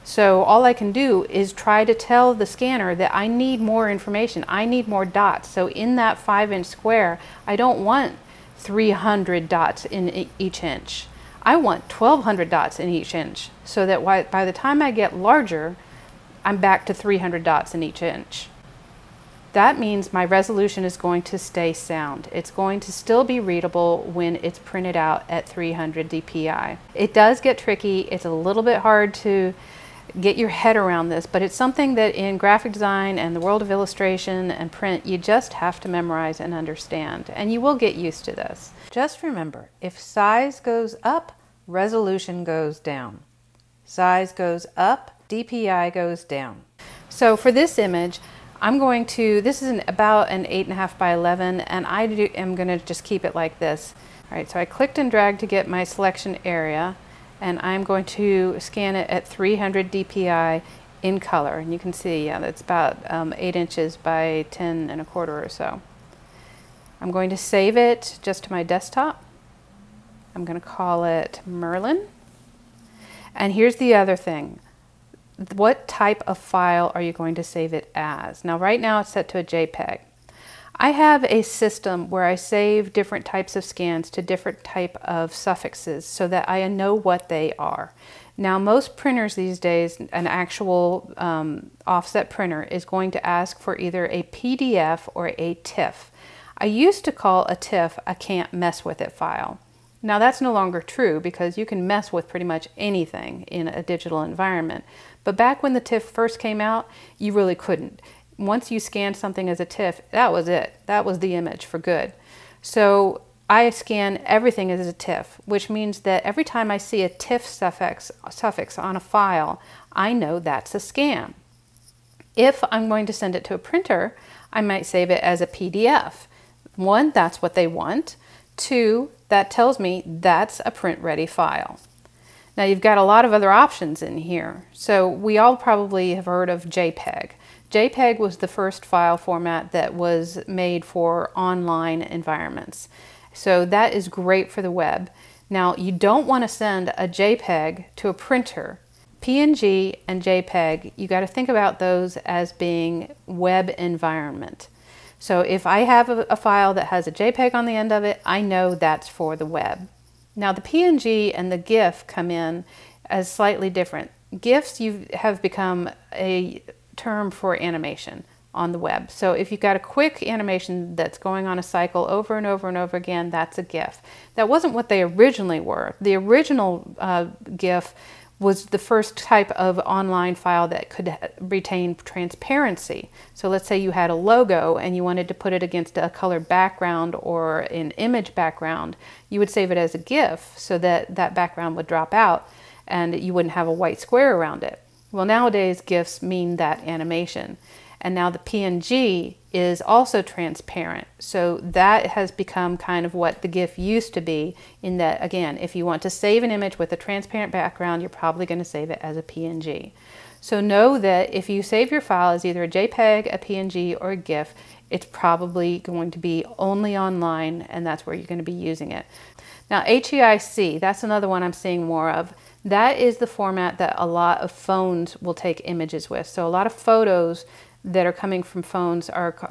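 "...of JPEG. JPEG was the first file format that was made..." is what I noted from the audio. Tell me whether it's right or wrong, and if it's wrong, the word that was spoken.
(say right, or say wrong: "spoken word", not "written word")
right.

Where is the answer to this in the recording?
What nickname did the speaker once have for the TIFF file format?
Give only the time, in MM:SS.
01:38.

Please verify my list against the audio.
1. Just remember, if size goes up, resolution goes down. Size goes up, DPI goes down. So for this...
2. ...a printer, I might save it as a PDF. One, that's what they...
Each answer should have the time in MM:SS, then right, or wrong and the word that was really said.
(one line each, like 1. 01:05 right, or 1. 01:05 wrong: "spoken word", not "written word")
1. 00:38 right
2. 02:03 right.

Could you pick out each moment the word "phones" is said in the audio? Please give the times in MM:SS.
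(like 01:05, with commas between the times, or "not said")
03:44, 03:48.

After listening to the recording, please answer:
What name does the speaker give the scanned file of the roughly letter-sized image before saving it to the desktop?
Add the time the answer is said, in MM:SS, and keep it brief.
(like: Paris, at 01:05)
Merlin, at 01:11.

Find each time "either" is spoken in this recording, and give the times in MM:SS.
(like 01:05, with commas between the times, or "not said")
01:33, 03:32.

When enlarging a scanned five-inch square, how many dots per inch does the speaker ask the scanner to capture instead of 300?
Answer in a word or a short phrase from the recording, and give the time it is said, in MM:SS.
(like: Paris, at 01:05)
1200, at 00:11.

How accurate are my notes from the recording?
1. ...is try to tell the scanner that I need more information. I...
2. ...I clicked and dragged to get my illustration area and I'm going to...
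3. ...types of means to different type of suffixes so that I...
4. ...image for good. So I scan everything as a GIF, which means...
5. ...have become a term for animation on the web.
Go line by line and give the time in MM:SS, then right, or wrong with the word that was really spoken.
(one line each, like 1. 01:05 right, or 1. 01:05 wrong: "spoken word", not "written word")
1. 00:01 right
2. 00:54 wrong: "selection", not "illustration"
3. 01:23 wrong: "scans", not "means"
4. 01:51 wrong: "TIFF", not "GIF"
5. 02:45 right.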